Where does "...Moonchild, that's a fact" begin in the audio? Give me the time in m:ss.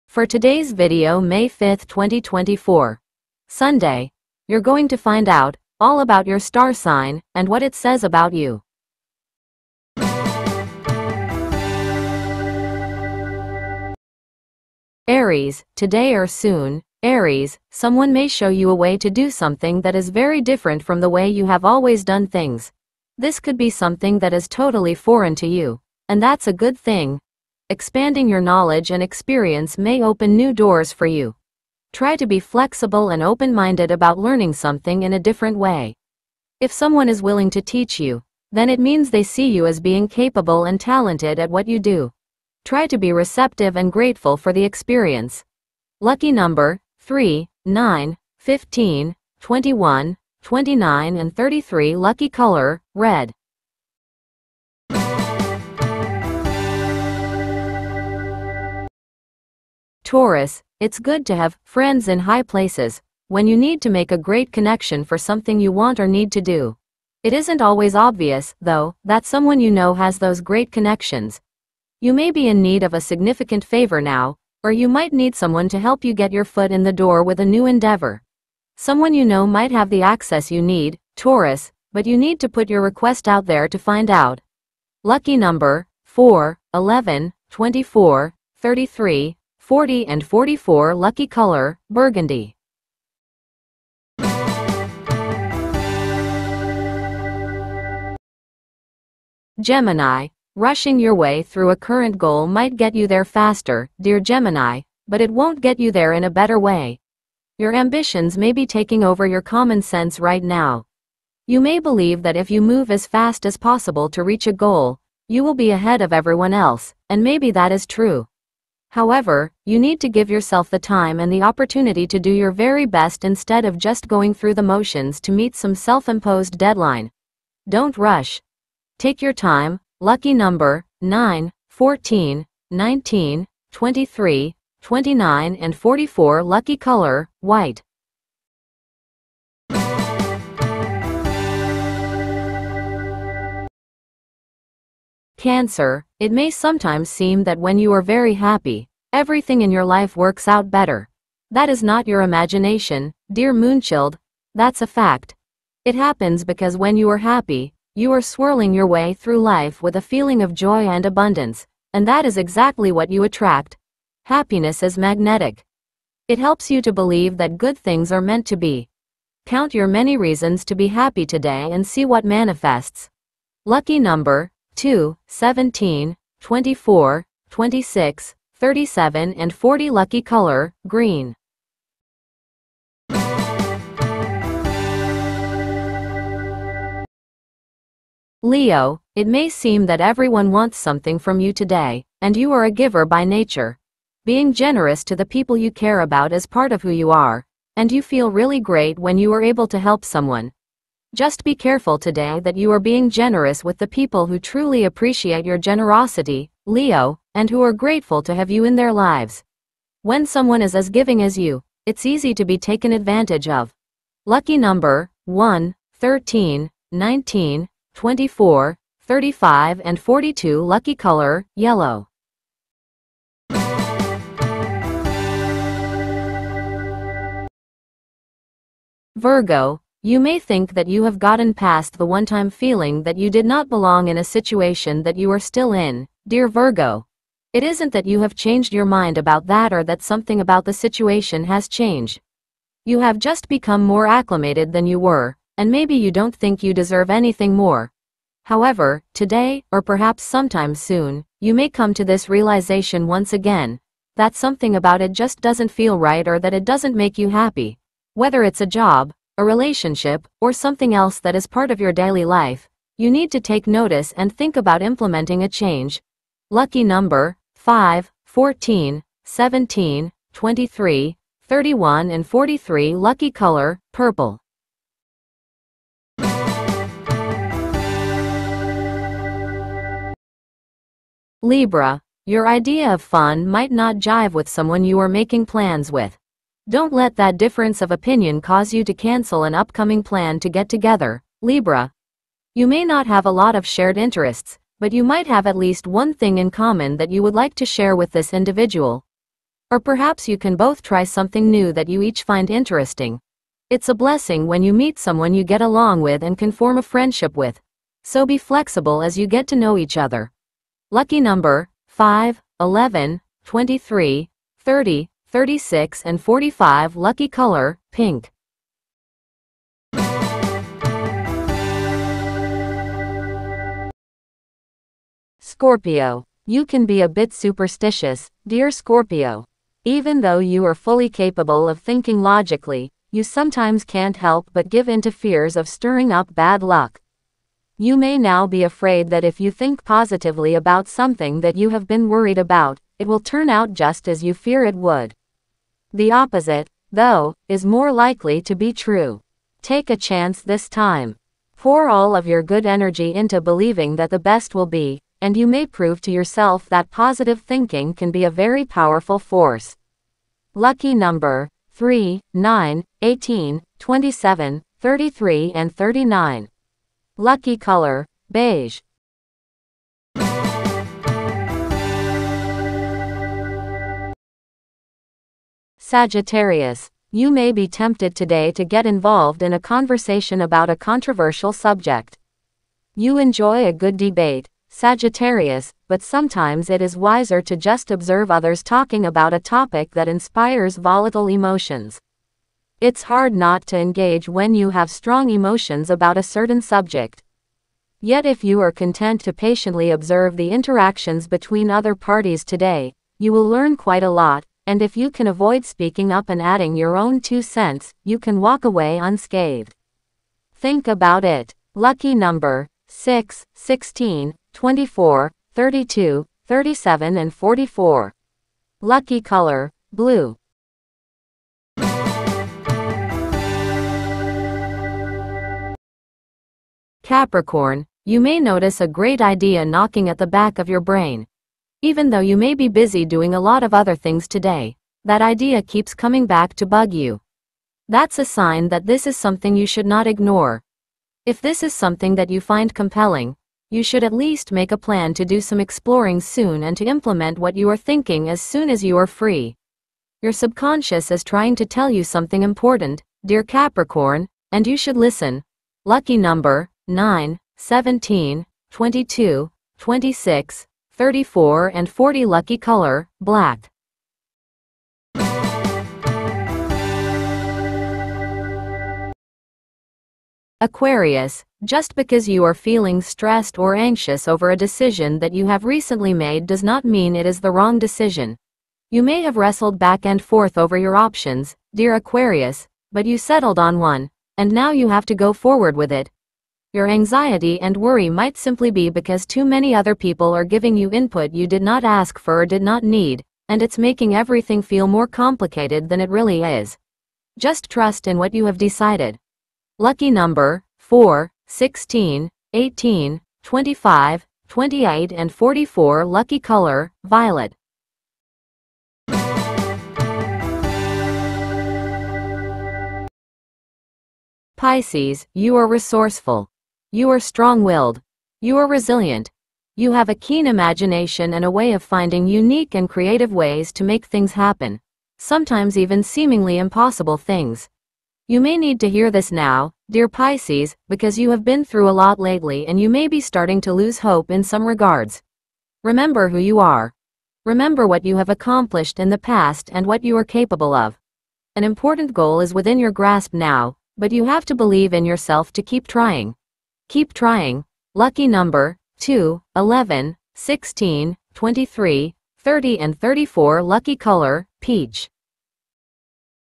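2:33.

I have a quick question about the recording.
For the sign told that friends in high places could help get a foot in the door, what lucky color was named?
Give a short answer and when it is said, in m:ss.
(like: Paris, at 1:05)
Burgundy, at 1:31.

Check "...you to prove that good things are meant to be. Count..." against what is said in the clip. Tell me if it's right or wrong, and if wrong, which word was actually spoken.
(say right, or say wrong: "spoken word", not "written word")
wrong: "believe", not "prove".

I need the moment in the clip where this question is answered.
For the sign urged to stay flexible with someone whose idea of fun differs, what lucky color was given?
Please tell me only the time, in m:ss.
5:17.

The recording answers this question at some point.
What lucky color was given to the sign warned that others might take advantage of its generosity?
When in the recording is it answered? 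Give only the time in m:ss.
3:41.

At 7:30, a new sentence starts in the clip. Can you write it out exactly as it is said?
Your subconscious is trying to tell you something important, dear Capricorn, and you should listen.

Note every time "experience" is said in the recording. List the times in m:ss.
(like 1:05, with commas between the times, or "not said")
0:29, 0:44.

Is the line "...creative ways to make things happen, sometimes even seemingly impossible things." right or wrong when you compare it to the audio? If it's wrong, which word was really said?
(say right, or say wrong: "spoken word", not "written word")
right.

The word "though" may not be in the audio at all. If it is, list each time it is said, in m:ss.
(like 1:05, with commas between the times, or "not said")
1:08, 5:30, 5:46, 7:12.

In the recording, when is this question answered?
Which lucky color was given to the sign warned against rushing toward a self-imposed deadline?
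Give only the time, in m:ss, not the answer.
2:17.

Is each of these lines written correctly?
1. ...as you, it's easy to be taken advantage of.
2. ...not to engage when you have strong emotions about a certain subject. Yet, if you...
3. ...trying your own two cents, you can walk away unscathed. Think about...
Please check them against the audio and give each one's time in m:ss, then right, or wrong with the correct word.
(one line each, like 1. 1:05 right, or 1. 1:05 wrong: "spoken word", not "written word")
1. 3:31 right
2. 6:33 right
3. 6:46 wrong: "adding", not "trying".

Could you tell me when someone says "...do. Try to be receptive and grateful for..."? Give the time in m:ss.
0:41.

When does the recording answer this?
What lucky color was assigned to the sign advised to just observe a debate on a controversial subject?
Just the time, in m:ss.
6:59.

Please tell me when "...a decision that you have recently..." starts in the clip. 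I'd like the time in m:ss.
7:54.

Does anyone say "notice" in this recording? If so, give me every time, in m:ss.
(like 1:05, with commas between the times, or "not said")
4:23, 7:08.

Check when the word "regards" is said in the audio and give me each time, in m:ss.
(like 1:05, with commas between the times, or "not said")
8:54.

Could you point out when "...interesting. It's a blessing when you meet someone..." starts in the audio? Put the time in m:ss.
5:02.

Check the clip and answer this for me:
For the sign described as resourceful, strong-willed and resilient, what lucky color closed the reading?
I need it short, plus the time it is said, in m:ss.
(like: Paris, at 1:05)
Peach, at 9:14.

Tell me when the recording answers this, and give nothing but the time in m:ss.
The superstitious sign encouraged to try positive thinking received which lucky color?
6:08.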